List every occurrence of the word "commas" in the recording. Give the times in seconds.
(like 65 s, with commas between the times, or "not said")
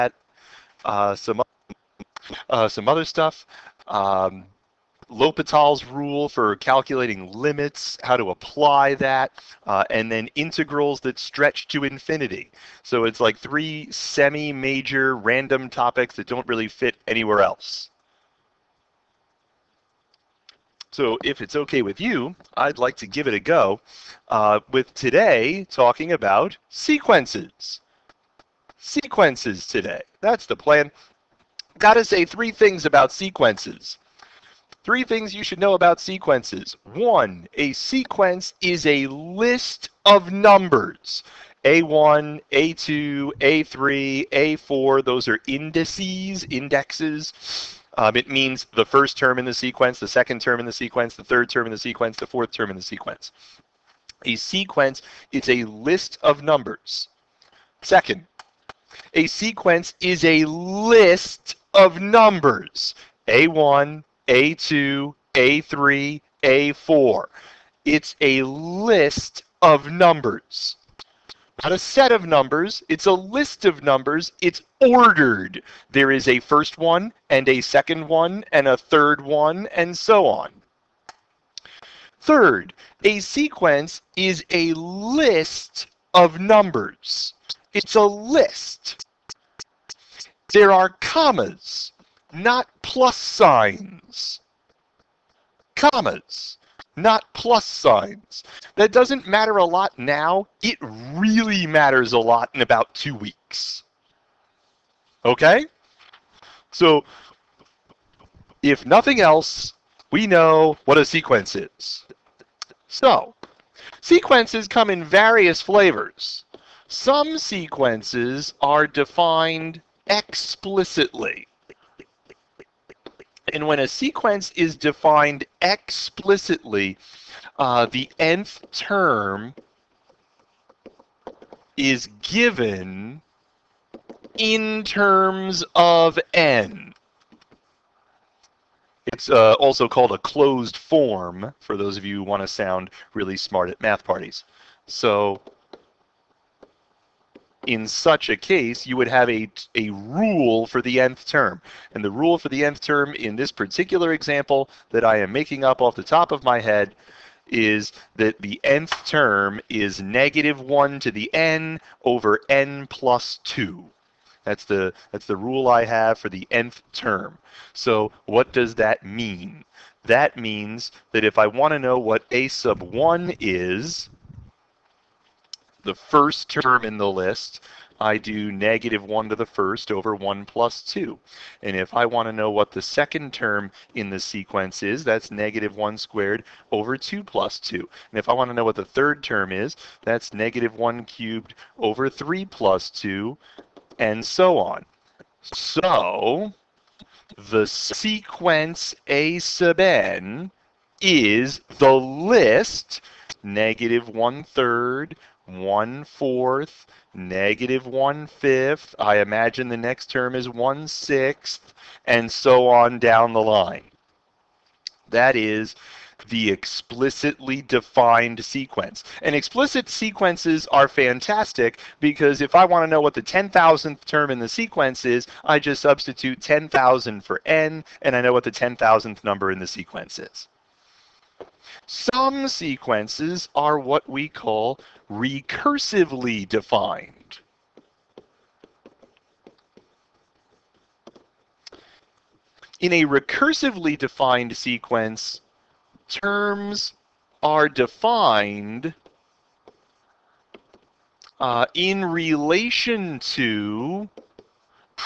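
90 s, 95 s.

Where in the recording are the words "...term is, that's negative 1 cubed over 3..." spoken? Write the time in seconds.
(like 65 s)
189 s.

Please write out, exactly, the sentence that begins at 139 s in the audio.
It's uh, also called a closed form, for those of you who want to sound really smart at math parties.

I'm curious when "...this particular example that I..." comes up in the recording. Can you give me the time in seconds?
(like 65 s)
153 s.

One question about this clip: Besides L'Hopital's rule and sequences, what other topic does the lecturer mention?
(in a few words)
integrals that stretch to infinity.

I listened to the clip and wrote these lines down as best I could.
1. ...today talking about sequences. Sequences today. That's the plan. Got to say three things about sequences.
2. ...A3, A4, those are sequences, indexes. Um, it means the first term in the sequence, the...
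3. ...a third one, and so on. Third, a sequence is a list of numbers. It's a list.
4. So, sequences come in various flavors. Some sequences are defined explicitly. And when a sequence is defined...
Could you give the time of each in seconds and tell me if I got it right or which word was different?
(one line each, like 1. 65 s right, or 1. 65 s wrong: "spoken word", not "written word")
1. 24 s right
2. 43 s wrong: "indices", not "sequences"
3. 78 s right
4. 112 s right.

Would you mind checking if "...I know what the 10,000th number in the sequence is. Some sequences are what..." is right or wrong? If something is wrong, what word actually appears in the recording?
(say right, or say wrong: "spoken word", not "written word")
right.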